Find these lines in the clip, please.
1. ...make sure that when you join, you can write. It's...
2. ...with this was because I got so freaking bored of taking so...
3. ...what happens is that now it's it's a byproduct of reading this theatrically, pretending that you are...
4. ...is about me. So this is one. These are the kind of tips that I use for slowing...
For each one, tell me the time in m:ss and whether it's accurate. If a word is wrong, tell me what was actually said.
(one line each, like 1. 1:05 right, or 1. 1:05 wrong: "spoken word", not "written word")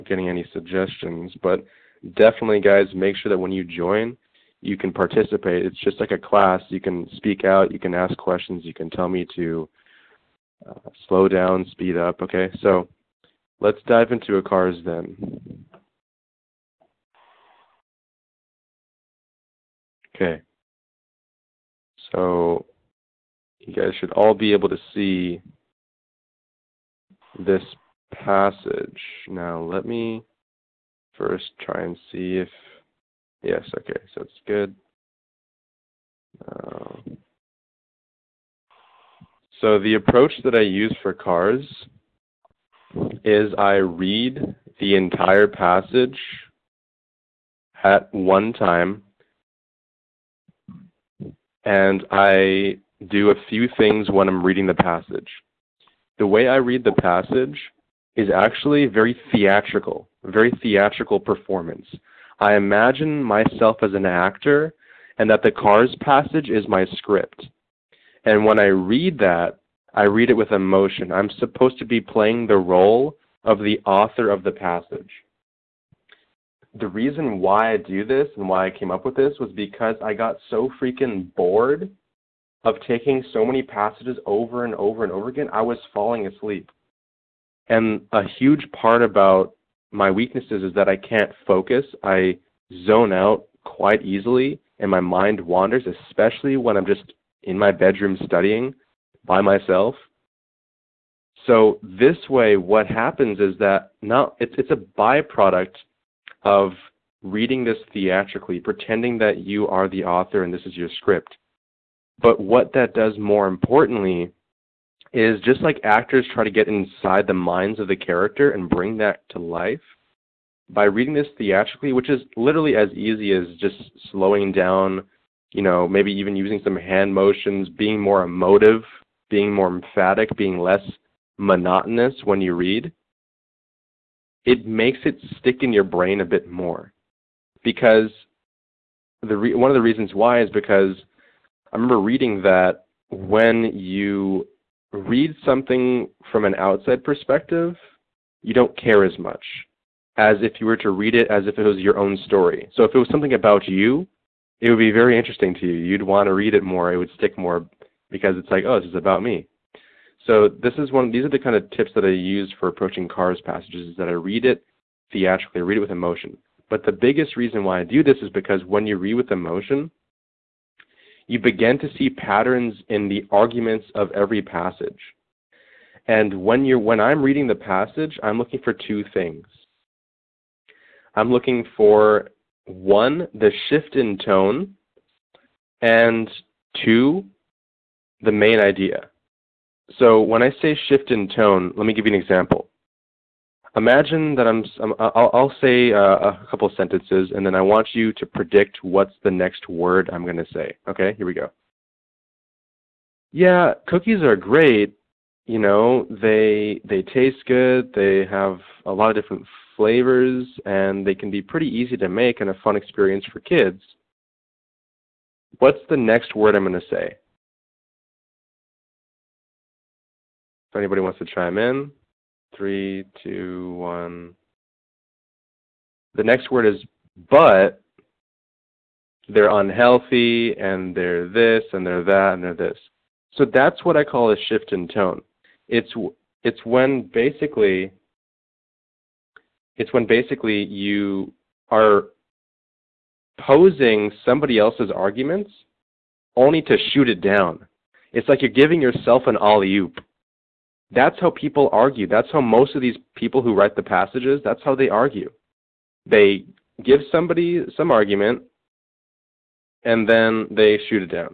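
1. 0:02 wrong: "participate", not "write"
2. 1:19 right
3. 1:42 right
4. 2:38 wrong: "approaching", not "slowing".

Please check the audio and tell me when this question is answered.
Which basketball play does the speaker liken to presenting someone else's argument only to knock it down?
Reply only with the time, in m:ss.
4:09.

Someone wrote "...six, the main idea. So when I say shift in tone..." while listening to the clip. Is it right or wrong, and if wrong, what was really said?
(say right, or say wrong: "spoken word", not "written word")
wrong: "two", not "six".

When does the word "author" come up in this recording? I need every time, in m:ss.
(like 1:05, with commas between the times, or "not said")
1:13, 1:50.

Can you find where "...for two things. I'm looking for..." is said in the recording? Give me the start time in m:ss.
2:58.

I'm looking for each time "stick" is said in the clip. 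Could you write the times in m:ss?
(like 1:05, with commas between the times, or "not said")
2:15, 2:37.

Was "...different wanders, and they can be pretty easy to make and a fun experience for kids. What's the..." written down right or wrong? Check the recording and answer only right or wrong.
wrong.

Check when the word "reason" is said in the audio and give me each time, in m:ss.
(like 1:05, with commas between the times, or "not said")
1:16, 2:19, 2:47.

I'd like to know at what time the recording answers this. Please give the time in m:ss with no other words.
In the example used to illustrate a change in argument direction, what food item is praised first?
3:23.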